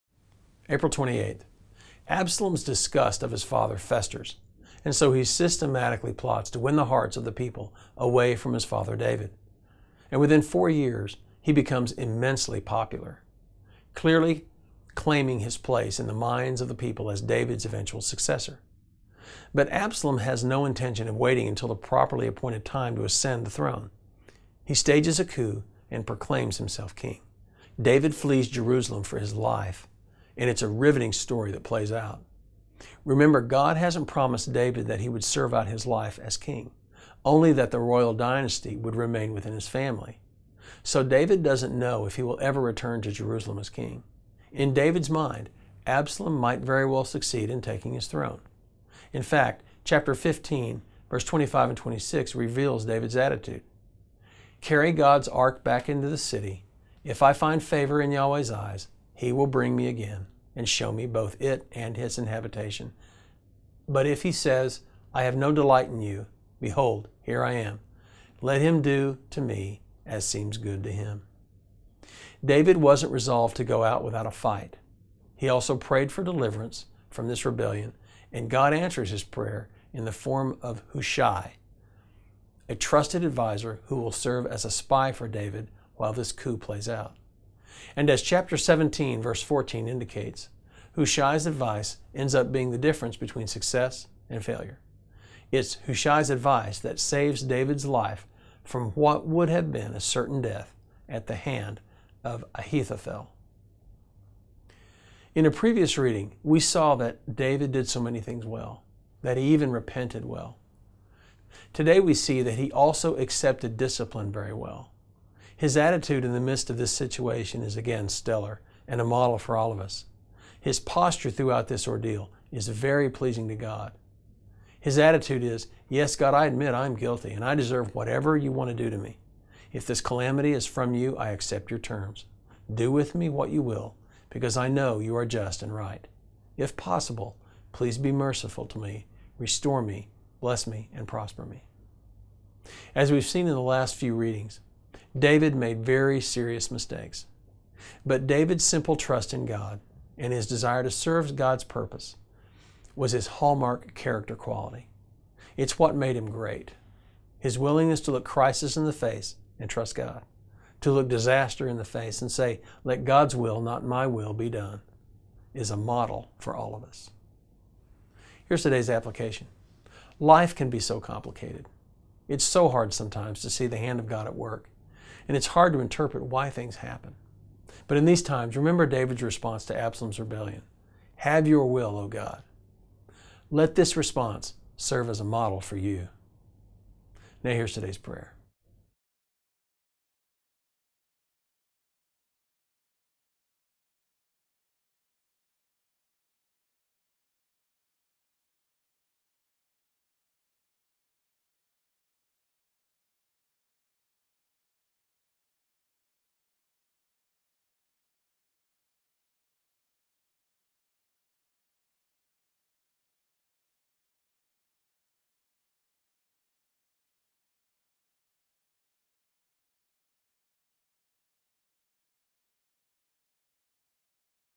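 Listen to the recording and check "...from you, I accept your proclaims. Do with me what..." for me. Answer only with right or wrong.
wrong.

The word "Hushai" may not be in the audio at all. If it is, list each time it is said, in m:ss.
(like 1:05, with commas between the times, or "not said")
1:20, 1:30, 1:35.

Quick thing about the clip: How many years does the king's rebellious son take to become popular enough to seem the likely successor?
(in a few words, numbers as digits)
4.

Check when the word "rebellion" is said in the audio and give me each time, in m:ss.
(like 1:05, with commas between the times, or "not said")
1:17, 3:00.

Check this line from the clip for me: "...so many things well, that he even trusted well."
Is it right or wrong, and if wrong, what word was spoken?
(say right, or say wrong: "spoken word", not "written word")
wrong: "repented", not "trusted".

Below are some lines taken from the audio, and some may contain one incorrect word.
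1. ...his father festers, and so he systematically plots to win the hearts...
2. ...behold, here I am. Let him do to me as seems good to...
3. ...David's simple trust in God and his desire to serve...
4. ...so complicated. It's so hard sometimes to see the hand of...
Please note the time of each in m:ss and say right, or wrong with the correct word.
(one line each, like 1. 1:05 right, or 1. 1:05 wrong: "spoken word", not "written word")
1. 0:03 right
2. 1:06 right
3. 2:28 right
4. 2:50 right.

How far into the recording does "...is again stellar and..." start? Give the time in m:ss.
1:57.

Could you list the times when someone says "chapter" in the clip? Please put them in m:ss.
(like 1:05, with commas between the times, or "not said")
0:49, 1:28.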